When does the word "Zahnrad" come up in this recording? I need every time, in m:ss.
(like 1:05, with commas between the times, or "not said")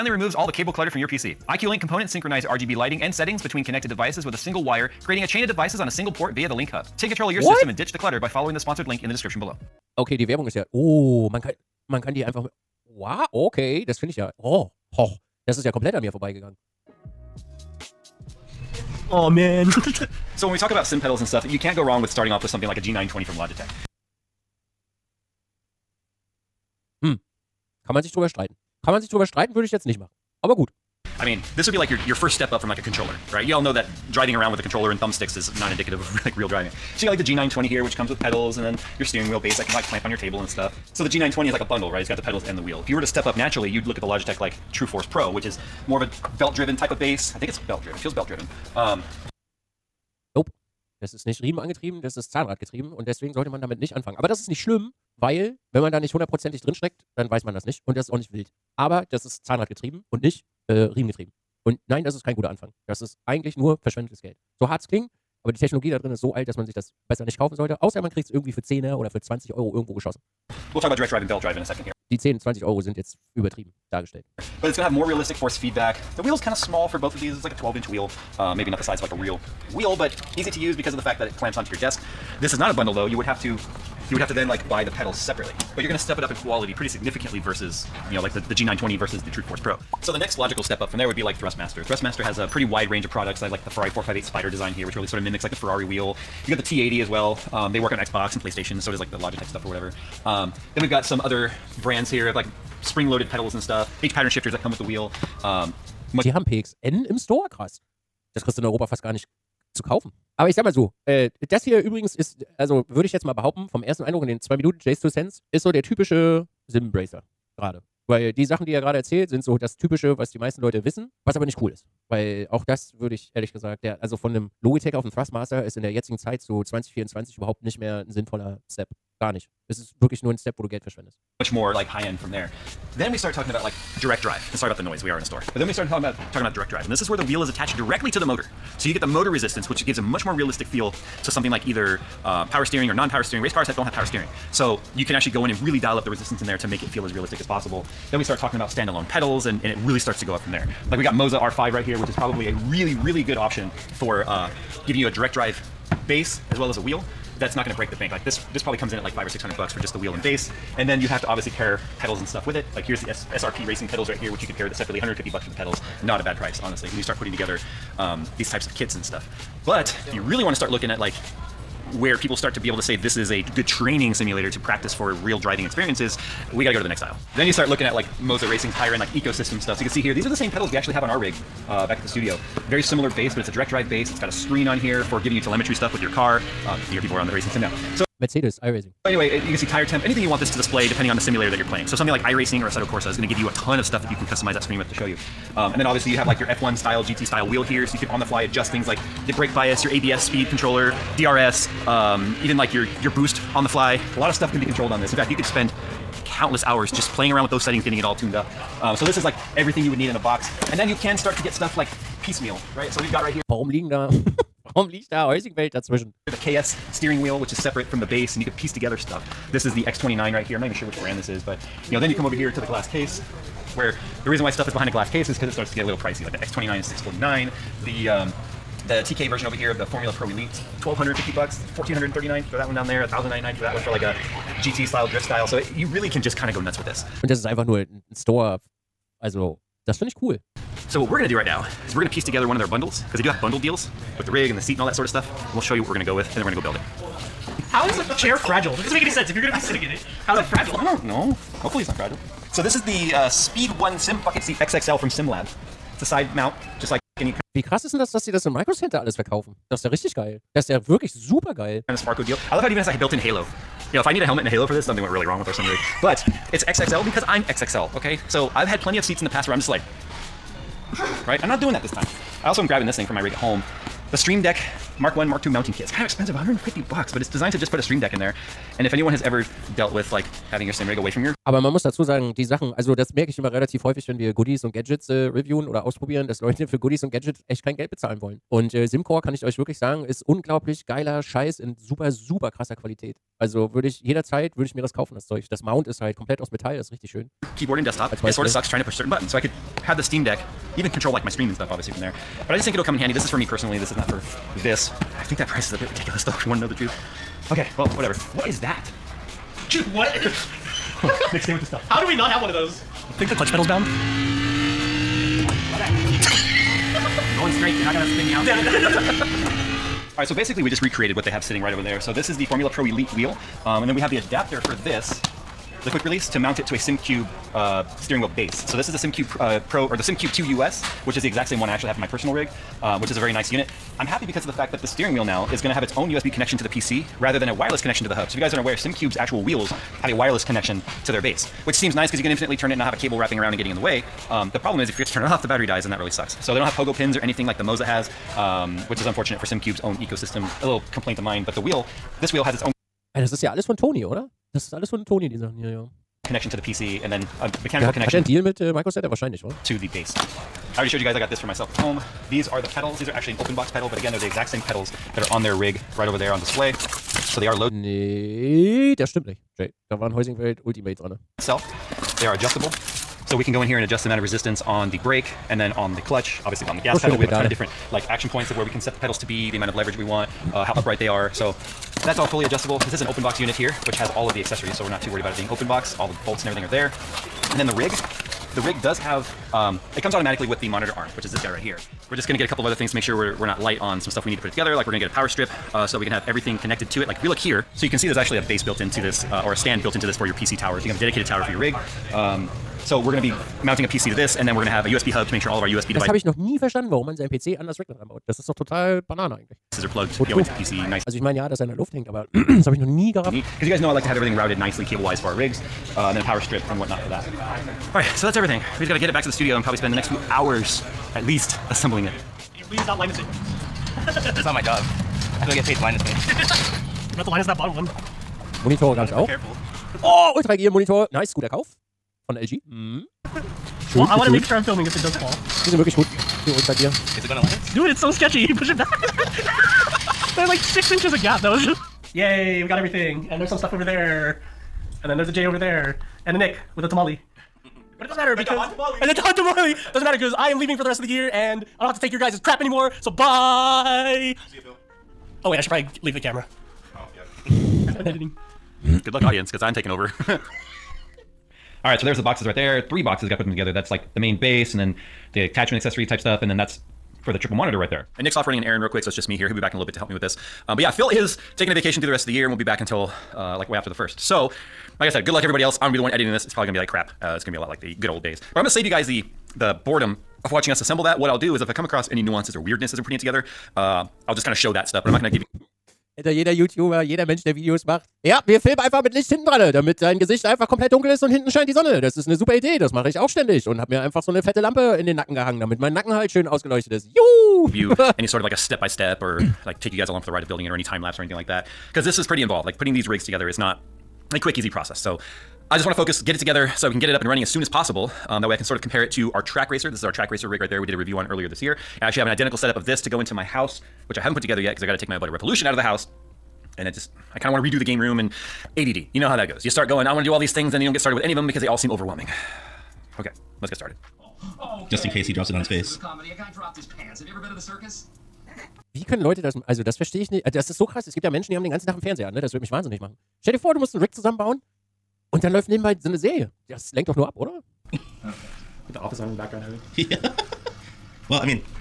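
0:52, 0:59.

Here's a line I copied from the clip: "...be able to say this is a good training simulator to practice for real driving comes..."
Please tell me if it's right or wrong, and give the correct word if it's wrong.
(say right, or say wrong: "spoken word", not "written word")
wrong: "experiences", not "comes".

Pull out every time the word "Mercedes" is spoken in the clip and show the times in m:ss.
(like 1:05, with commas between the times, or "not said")
3:08.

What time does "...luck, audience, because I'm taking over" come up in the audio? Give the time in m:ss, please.
7:39.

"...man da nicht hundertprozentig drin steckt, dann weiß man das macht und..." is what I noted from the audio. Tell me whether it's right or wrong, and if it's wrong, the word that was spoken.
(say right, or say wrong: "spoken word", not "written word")
wrong: "nicht", not "macht".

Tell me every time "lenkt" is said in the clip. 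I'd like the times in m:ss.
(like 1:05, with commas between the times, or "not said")
8:56.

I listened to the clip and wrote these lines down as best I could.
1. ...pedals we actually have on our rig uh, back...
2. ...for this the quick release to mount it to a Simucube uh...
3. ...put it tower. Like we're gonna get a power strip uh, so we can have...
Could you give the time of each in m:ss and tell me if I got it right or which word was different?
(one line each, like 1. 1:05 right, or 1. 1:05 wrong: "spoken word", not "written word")
1. 3:00 right
2. 5:24 right
3. 6:34 wrong: "together", not "tower".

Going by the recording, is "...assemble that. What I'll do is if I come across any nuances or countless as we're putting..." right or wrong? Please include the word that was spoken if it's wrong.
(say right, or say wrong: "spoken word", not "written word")
wrong: "weirdness", not "countless".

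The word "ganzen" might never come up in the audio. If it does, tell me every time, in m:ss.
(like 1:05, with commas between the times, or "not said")
8:51.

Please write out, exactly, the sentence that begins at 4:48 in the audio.
Und äh, Simcore kann ich euch wirklich sagen, ist unglaublich geiler Scheiß in super, super krasser Qualität.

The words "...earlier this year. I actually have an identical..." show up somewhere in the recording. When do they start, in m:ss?
8:31.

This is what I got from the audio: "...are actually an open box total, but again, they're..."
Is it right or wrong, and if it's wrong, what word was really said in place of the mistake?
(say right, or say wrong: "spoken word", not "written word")
wrong: "pedal", not "total".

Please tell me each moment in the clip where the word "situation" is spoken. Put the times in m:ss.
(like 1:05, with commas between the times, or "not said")
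not said.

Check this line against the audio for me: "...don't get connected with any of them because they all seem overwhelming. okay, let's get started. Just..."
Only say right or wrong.
wrong.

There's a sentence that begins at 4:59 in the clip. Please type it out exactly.
So I could have the Steam Deck even control like my stream and stuff obviously from there.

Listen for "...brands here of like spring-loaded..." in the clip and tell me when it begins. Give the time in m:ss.
1:41.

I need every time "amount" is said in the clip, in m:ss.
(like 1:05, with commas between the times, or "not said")
6:14, 6:19.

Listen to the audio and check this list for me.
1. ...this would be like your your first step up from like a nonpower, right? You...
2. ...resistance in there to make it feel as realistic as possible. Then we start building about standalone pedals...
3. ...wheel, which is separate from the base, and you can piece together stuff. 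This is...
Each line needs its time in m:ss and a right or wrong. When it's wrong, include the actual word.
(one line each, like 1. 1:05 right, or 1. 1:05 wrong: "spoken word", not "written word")
1. 0:31 wrong: "controller", not "nonpower"
2. 2:26 wrong: "talking", not "building"
3. 3:37 right.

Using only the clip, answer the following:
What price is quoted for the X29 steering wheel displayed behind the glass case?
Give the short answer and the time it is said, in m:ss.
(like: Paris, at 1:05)
649, at 3:46.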